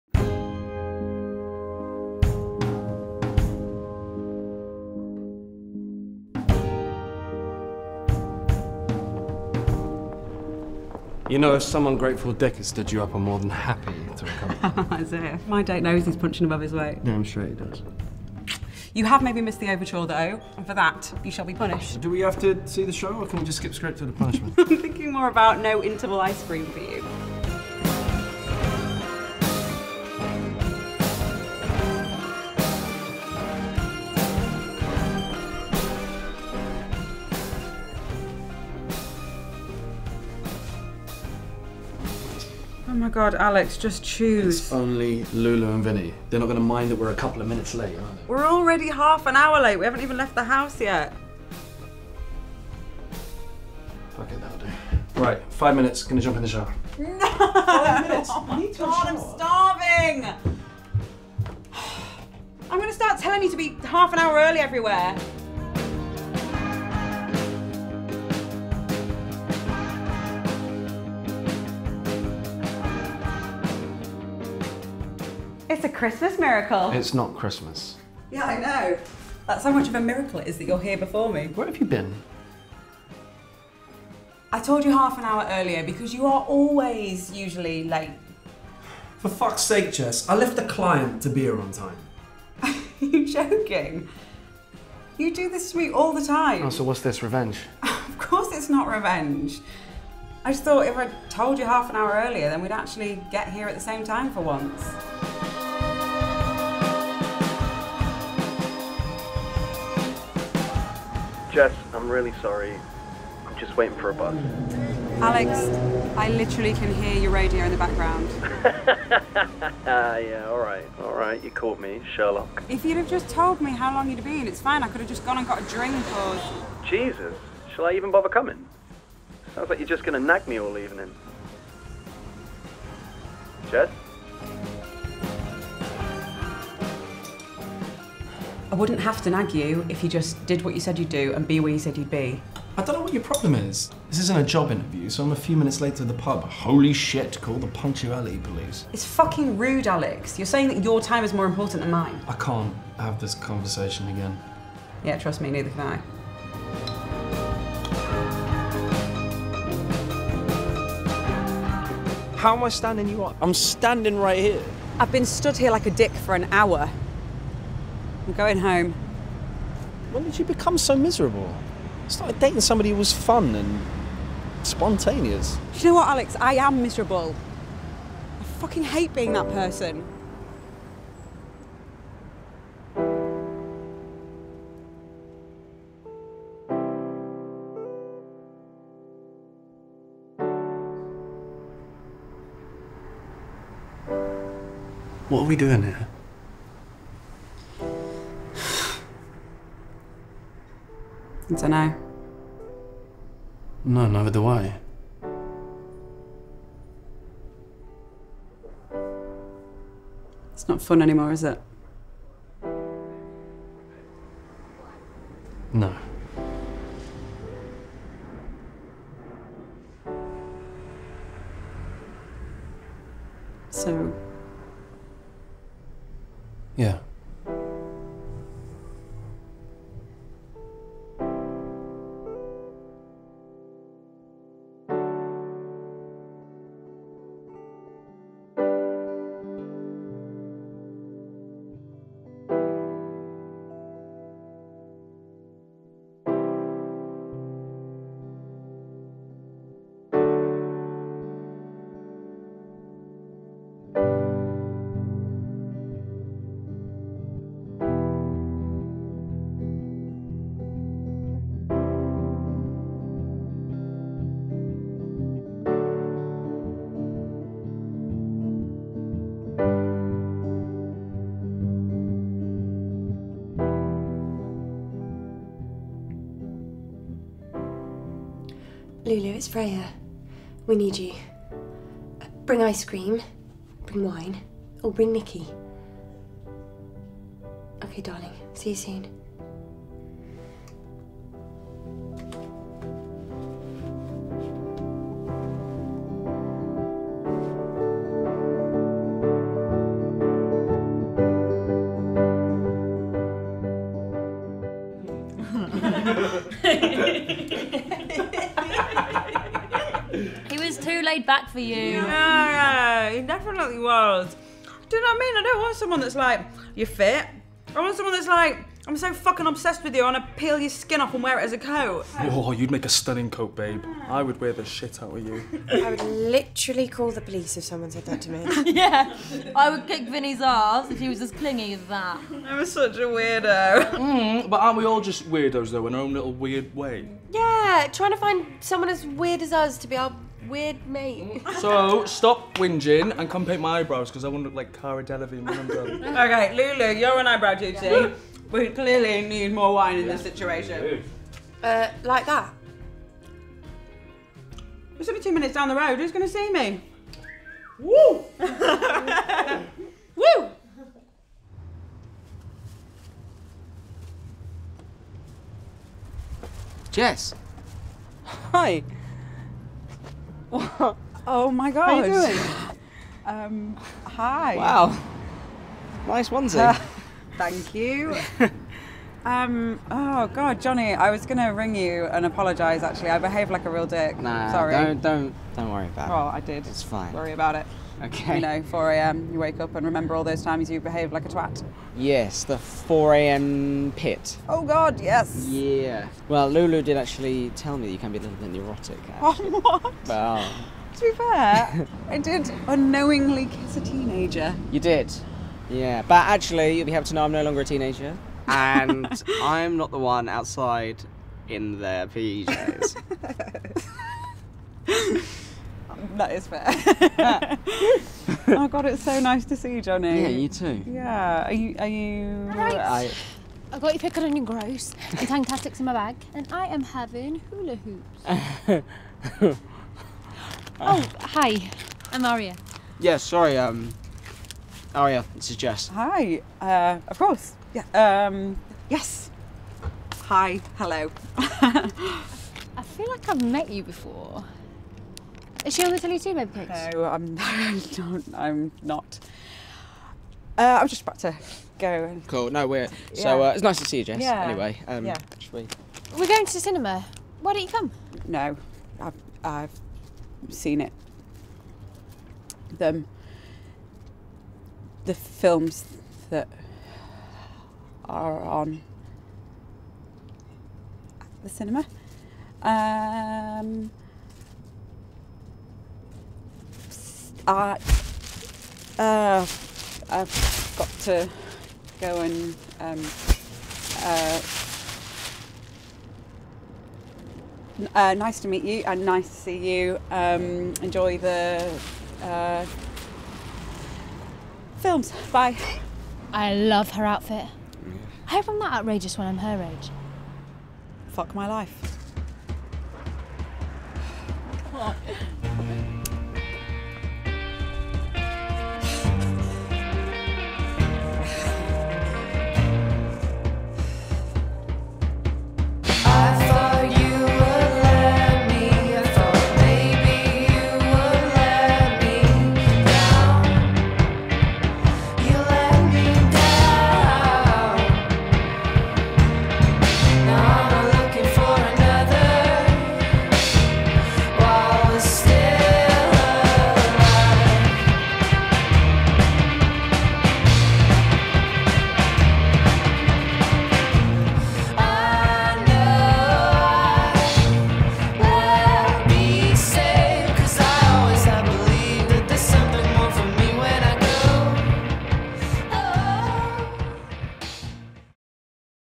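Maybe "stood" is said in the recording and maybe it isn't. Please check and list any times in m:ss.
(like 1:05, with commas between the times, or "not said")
0:12, 2:45.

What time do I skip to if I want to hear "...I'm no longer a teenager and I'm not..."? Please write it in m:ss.
6:47.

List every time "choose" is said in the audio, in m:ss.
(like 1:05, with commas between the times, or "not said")
0:44.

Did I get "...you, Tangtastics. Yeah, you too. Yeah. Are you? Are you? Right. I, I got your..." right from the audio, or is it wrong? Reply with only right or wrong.
wrong.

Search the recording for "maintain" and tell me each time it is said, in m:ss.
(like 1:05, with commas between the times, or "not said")
not said.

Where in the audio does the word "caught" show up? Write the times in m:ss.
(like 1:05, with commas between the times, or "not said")
2:01.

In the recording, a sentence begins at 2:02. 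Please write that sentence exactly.
If you'd have just told me how long you'd been, it's fine.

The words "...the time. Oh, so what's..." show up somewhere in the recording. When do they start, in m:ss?
1:36.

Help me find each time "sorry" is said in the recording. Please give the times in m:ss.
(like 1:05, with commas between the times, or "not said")
1:52, 6:24, 7:13.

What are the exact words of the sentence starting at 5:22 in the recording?
Oh, you'd make a stunning coat, babe.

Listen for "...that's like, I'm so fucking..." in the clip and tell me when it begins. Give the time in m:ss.
5:18.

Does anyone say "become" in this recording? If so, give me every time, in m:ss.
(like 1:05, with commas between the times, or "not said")
2:50.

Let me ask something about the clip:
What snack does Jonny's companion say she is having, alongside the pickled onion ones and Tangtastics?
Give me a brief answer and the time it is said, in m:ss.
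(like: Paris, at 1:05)
Hula Hoops, at 7:07.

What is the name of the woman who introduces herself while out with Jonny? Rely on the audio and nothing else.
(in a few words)
Aria.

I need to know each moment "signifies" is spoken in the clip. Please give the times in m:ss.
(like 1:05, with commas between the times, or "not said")
not said.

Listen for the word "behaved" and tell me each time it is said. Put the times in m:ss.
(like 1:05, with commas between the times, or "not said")
6:23, 6:30.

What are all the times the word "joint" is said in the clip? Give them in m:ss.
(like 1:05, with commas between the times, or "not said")
not said.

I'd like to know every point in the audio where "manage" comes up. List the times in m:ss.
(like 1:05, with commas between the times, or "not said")
not said.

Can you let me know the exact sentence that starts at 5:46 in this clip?
okay, Lulu, you're on eyebrow duty.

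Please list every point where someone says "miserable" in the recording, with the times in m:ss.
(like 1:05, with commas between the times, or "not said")
2:50, 2:56.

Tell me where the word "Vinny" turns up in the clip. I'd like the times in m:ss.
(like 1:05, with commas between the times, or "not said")
0:45, 5:30.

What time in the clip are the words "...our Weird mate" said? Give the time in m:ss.
5:39.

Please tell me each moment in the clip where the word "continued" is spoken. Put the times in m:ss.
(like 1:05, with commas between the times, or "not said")
not said.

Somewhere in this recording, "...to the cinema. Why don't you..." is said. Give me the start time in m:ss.
7:36.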